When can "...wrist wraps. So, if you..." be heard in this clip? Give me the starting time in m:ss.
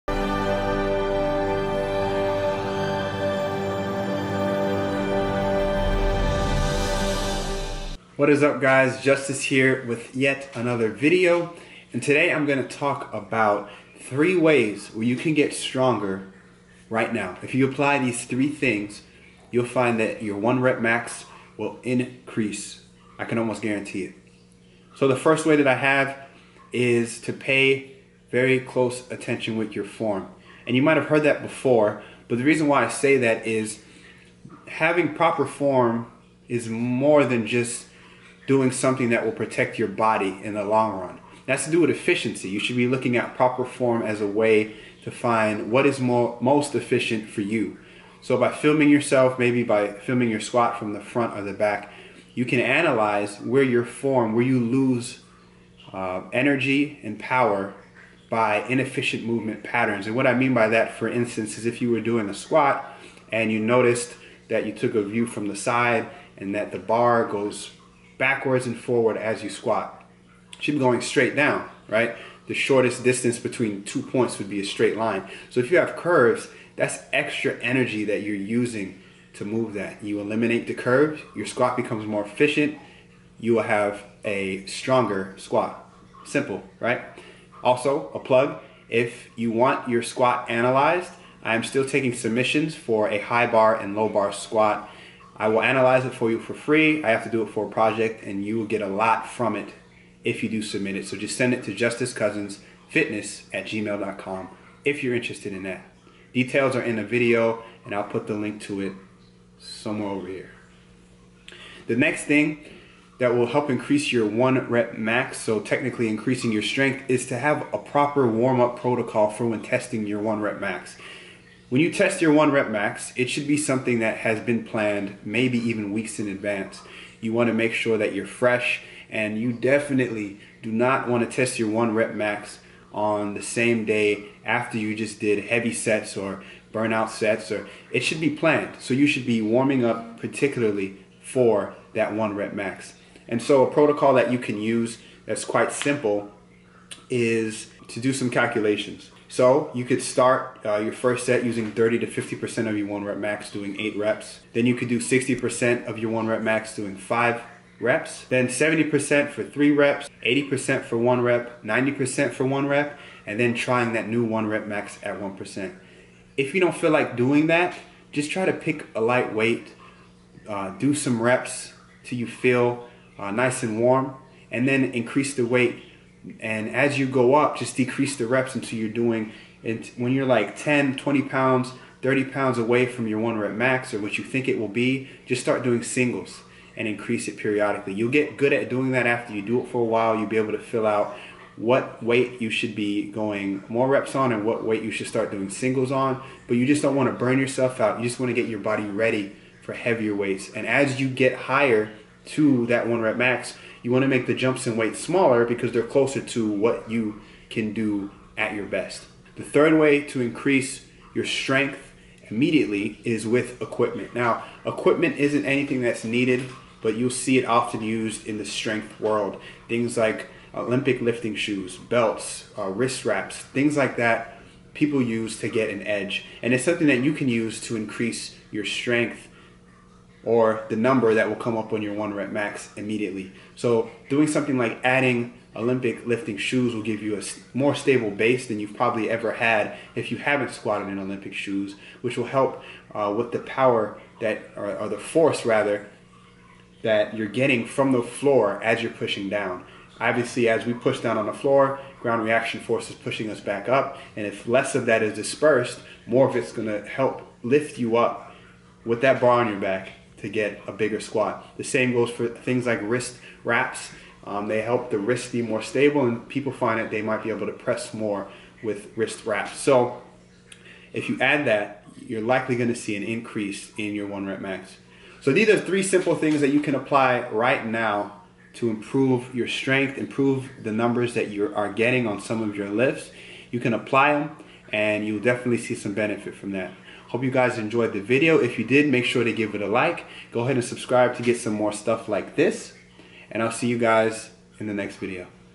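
4:28.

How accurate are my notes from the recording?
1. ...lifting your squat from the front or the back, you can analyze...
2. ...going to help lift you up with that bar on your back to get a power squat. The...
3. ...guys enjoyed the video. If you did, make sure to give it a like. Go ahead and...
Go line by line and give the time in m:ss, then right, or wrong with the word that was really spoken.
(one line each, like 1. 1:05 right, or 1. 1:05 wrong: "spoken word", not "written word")
1. 0:49 wrong: "filming", not "lifting"
2. 4:16 wrong: "bigger", not "power"
3. 4:47 right.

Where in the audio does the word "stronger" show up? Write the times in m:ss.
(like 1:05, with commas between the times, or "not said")
0:15, 1:24.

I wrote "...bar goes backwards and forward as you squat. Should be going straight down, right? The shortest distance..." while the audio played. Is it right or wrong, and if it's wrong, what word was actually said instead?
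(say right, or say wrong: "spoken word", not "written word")
right.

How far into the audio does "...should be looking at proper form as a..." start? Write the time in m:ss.
0:42.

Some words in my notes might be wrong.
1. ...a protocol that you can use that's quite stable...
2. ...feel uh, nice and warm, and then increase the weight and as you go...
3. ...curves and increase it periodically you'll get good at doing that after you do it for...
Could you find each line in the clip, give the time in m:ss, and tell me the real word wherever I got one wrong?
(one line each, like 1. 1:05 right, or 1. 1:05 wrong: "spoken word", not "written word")
1. 2:23 wrong: "simple", not "stable"
2. 2:52 right
3. 3:05 wrong: "singles", not "curves".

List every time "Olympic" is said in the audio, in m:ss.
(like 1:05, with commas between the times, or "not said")
3:40, 3:55, 4:00.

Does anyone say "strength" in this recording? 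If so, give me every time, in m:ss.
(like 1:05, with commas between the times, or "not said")
1:56, 3:31, 3:38, 3:48, 4:39.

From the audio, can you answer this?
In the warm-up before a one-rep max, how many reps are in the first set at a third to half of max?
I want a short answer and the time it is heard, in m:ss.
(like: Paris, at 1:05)
8, at 2:33.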